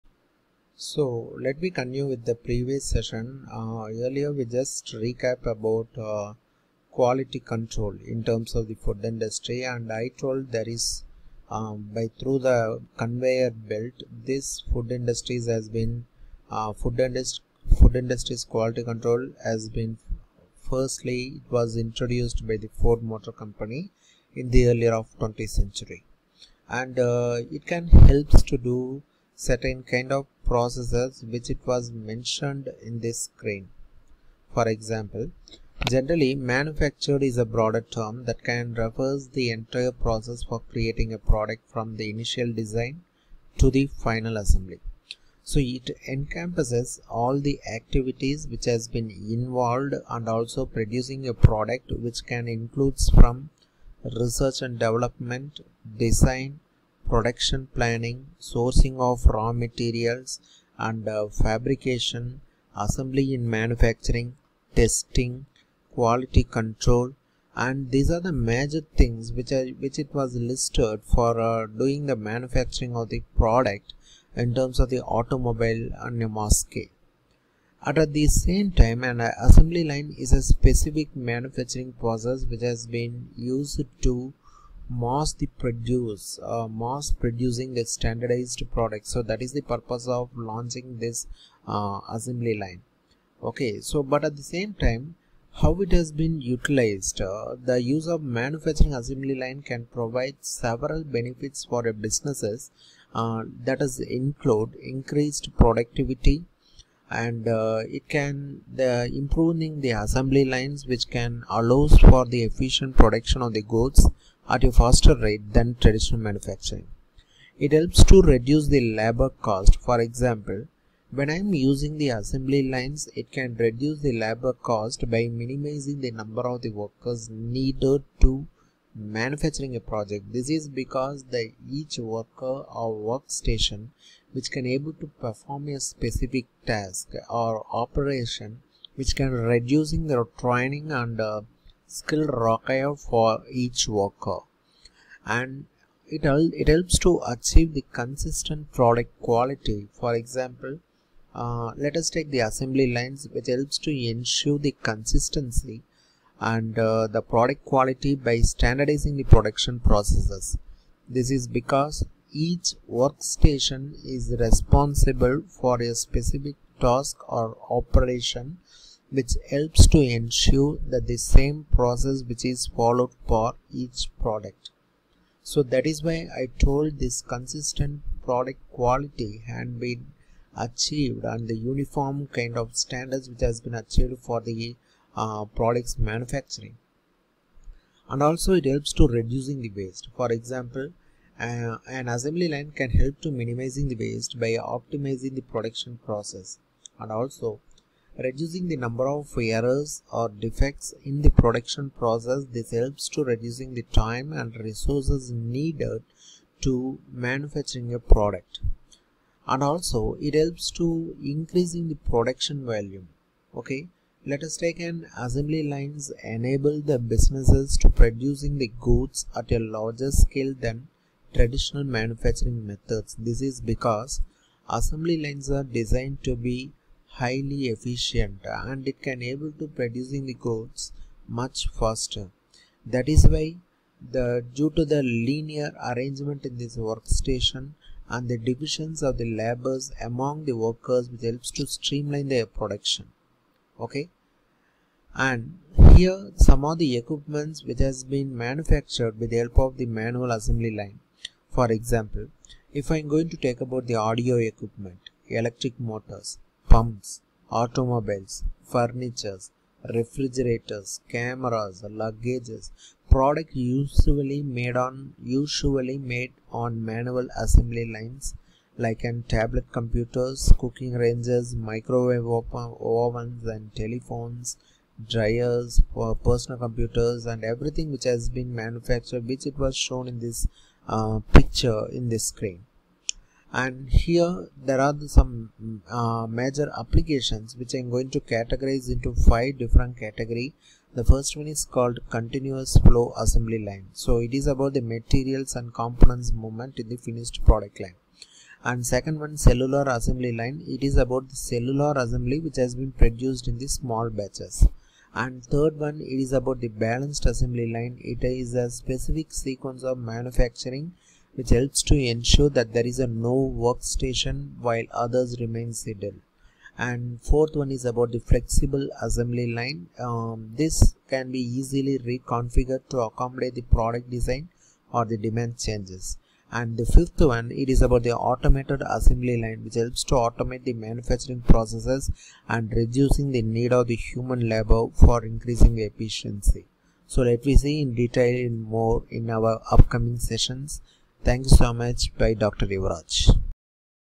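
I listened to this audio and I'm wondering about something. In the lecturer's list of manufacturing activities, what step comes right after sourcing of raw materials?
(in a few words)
Fabrication.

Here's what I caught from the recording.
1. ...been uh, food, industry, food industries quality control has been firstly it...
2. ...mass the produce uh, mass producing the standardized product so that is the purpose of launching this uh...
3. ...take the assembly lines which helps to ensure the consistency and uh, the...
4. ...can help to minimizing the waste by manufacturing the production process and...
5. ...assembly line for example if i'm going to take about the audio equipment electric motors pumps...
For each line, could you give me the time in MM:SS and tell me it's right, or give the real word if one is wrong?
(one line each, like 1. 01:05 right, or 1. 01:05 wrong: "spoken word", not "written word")
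1. 00:15 right
2. 01:24 right
3. 02:32 right
4. 03:12 wrong: "optimizing", not "manufacturing"
5. 04:10 right.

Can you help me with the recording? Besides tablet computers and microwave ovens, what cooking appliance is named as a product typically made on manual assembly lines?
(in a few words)
Cooking ranges.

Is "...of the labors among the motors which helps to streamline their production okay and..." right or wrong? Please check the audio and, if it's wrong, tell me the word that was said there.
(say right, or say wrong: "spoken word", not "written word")
wrong: "workers", not "motors".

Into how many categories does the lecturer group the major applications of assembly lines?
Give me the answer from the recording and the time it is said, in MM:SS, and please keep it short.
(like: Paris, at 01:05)
5, at 04:49.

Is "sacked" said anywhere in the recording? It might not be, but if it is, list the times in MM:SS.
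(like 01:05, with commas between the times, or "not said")
not said.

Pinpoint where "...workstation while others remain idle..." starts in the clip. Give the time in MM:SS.
05:13.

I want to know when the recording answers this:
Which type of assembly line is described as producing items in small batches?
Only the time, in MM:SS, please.
04:59.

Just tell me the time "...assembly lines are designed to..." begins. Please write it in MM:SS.
03:44.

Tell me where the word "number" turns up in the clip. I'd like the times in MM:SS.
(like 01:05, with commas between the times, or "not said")
02:06, 03:18.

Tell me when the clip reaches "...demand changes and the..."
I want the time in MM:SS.
05:25.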